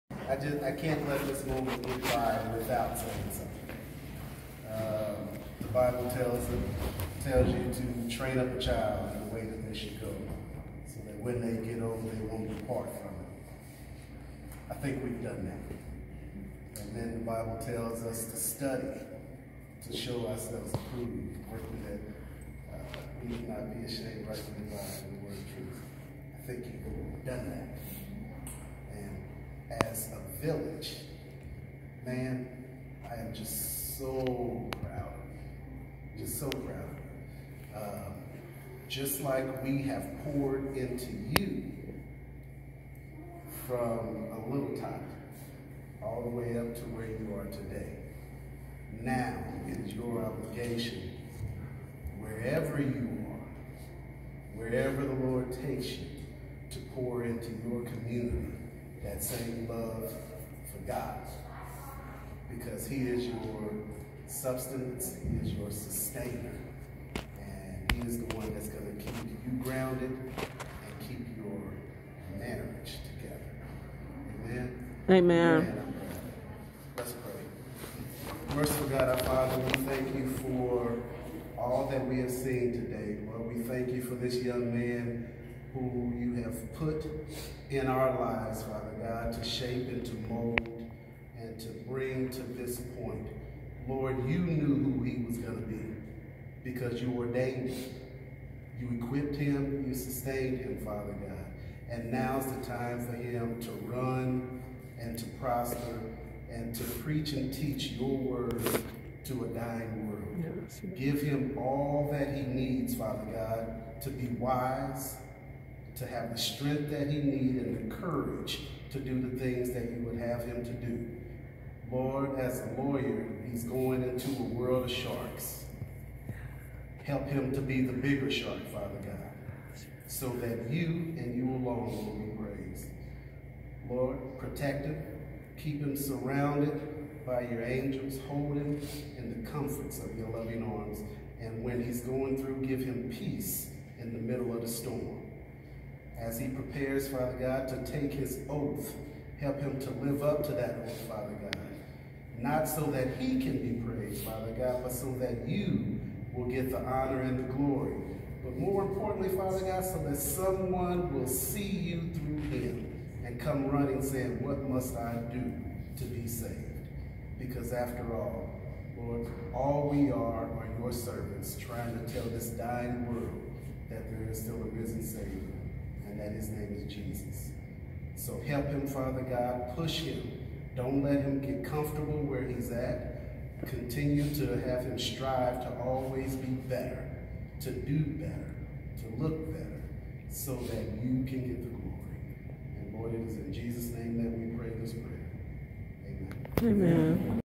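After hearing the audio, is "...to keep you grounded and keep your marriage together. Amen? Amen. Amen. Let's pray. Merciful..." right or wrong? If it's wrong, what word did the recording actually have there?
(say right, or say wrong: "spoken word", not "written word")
right.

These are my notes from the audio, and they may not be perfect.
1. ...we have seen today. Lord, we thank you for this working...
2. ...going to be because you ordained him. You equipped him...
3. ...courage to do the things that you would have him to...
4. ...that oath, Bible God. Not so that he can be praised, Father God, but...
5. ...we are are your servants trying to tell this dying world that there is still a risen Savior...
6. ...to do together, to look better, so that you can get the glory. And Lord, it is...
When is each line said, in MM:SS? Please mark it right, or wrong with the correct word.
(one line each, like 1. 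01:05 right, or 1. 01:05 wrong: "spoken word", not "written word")
1. 01:22 wrong: "young", not "working"
2. 01:35 right
3. 01:57 right
4. 02:30 wrong: "Father", not "Bible"
5. 02:49 right
6. 03:07 wrong: "better", not "together".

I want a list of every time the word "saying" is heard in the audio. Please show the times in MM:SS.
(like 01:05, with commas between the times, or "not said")
00:02, 02:44.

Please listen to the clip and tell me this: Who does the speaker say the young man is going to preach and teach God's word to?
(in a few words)
A dying world.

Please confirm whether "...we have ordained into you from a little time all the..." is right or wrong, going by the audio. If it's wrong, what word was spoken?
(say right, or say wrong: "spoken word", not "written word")
wrong: "poured", not "ordained".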